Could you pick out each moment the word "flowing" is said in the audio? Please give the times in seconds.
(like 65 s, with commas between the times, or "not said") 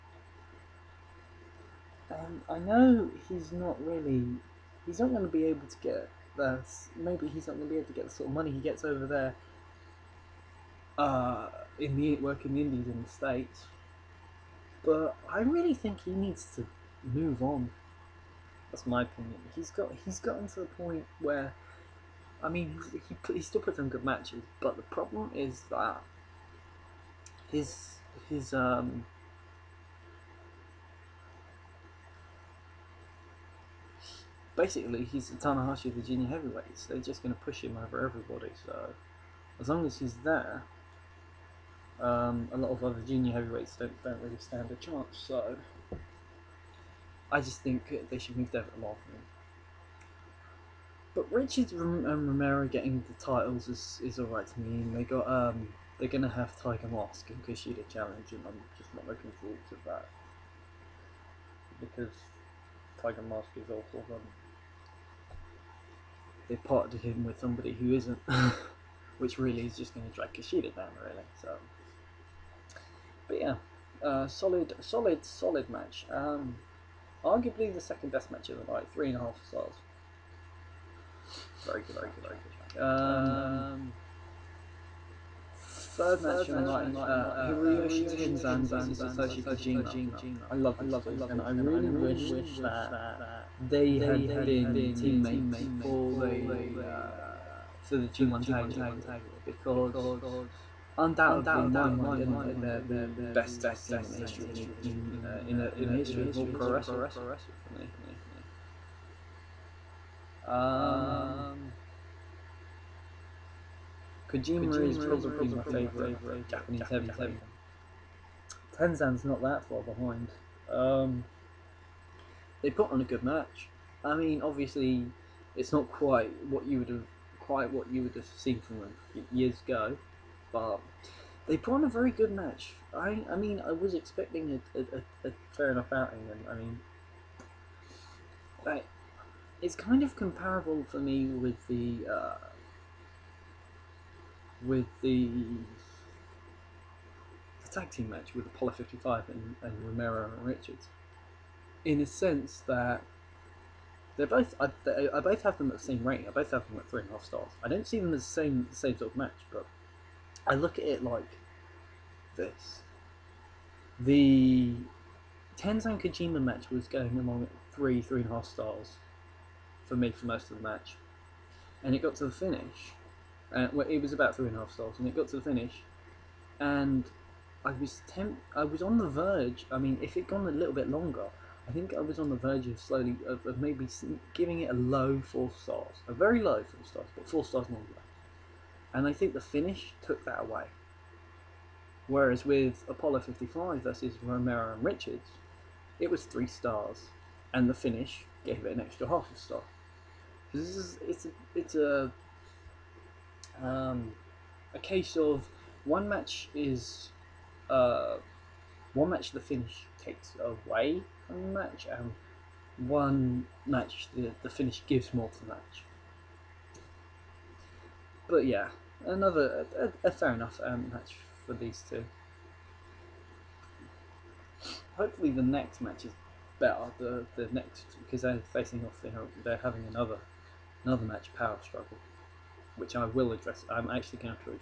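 not said.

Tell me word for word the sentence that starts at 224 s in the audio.
Hopefully the next match is better.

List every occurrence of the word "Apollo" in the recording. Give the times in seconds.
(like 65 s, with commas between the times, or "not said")
148 s, 192 s.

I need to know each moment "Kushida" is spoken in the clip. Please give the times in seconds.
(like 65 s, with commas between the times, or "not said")
57 s, 70 s.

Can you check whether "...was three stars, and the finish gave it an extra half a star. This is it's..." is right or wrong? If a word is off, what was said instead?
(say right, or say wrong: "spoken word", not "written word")
right.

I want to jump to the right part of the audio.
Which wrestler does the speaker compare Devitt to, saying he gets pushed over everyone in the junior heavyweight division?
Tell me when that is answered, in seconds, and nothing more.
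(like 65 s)
35 s.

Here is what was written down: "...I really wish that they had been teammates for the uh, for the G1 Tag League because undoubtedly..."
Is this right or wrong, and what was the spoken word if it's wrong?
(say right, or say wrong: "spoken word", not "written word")
right.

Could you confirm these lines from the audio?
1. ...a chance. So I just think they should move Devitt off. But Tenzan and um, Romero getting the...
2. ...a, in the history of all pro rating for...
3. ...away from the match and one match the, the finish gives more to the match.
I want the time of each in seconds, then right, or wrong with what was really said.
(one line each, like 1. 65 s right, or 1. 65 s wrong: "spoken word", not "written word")
1. 44 s wrong: "Richard", not "Tenzan"
2. 105 s wrong: "wrestling", not "rating"
3. 210 s right.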